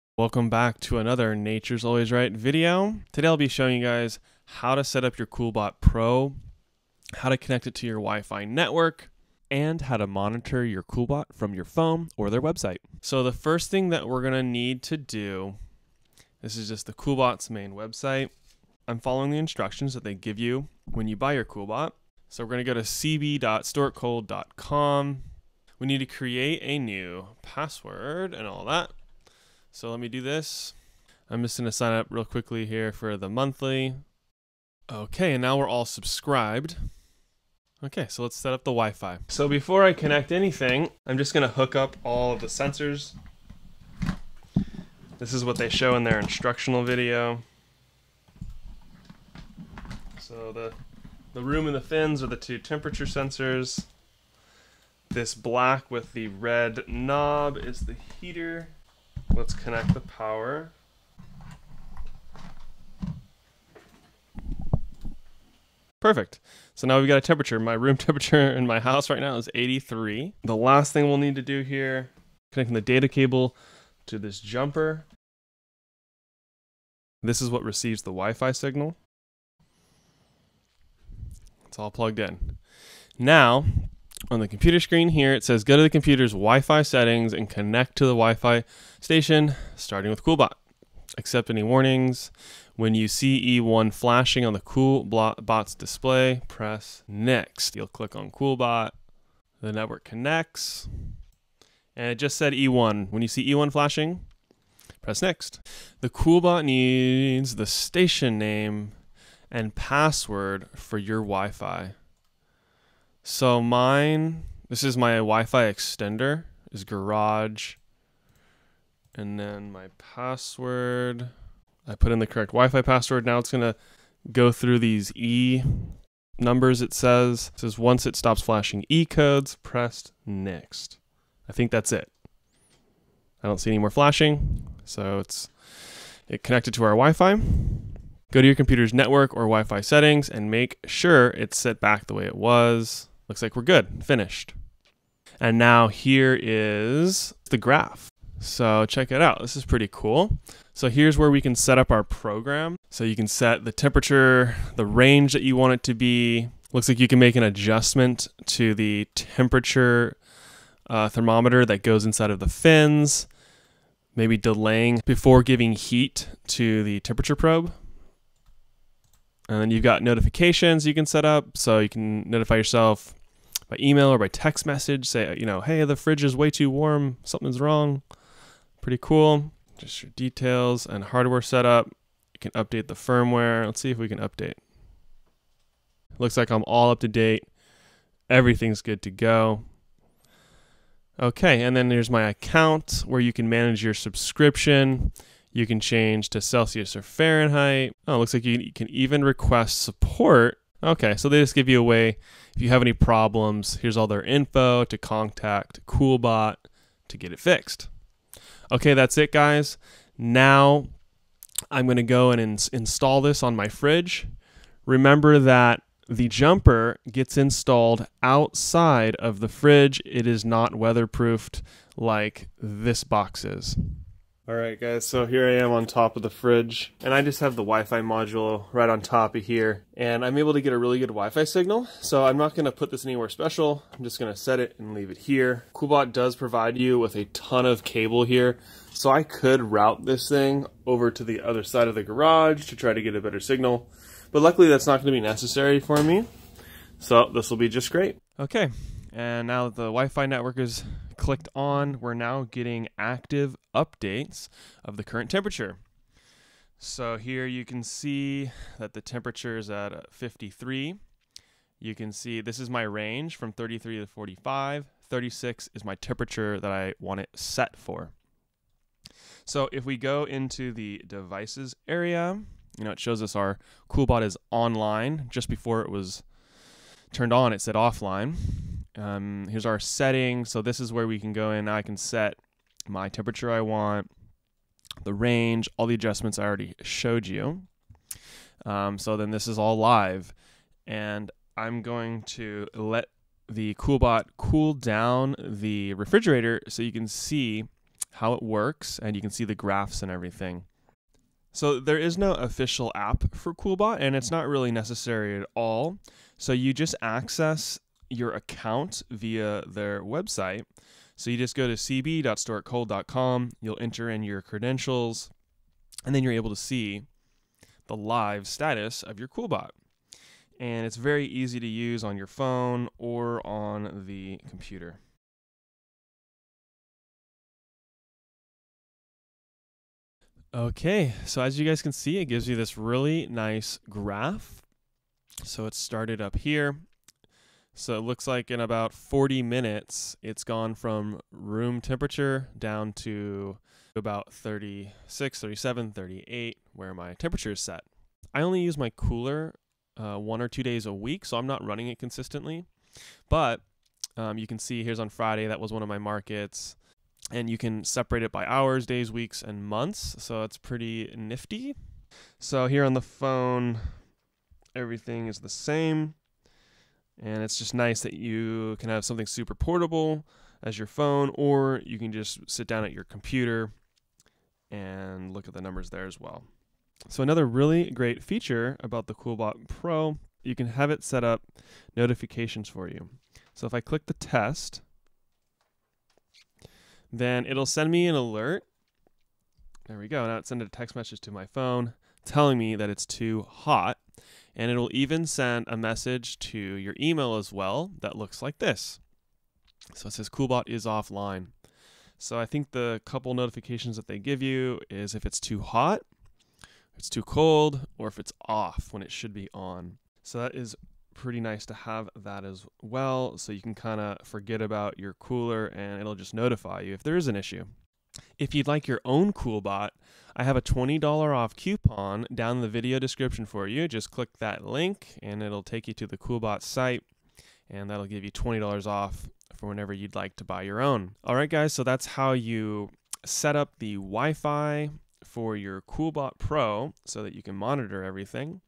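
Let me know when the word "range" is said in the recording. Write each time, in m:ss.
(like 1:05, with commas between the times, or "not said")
2:34, 4:22, 4:45.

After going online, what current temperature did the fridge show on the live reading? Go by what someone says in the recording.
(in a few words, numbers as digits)
53.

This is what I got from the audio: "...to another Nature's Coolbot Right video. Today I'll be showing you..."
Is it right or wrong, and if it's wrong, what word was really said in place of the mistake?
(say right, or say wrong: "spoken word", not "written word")
wrong: "Always", not "Coolbot".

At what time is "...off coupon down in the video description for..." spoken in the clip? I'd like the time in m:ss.
7:01.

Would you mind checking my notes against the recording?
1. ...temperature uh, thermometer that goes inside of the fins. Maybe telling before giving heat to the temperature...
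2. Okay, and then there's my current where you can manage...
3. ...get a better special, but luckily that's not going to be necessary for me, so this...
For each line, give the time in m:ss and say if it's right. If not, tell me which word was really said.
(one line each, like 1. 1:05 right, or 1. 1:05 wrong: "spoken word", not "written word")
1. 2:39 wrong: "delaying", not "telling"
2. 3:11 wrong: "account", not "current"
3. 4:03 wrong: "signal", not "special".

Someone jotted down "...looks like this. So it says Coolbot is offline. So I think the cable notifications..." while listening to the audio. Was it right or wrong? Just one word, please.
wrong.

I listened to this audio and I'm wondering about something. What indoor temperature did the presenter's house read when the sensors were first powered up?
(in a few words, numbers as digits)
83.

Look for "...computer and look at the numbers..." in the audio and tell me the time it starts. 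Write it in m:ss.
6:13.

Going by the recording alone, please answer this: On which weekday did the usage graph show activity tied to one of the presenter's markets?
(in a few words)
Friday.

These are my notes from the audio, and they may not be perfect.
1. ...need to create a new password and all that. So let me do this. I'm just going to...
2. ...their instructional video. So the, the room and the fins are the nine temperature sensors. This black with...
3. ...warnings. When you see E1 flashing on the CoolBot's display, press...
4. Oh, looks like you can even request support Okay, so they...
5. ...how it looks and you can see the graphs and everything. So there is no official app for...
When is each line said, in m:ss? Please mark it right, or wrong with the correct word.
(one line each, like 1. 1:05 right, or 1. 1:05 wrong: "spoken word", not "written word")
1. 0:25 right
2. 0:46 wrong: "two", not "nine"
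3. 1:31 right
4. 3:18 right
5. 4:58 wrong: "works", not "looks".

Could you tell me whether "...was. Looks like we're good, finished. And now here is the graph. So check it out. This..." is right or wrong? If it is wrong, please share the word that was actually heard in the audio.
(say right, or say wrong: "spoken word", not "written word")
right.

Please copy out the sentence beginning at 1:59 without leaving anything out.
And then my password, I put in the correct Wi-Fi password.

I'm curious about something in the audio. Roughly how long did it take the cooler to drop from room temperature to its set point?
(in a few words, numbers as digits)
40 minutes.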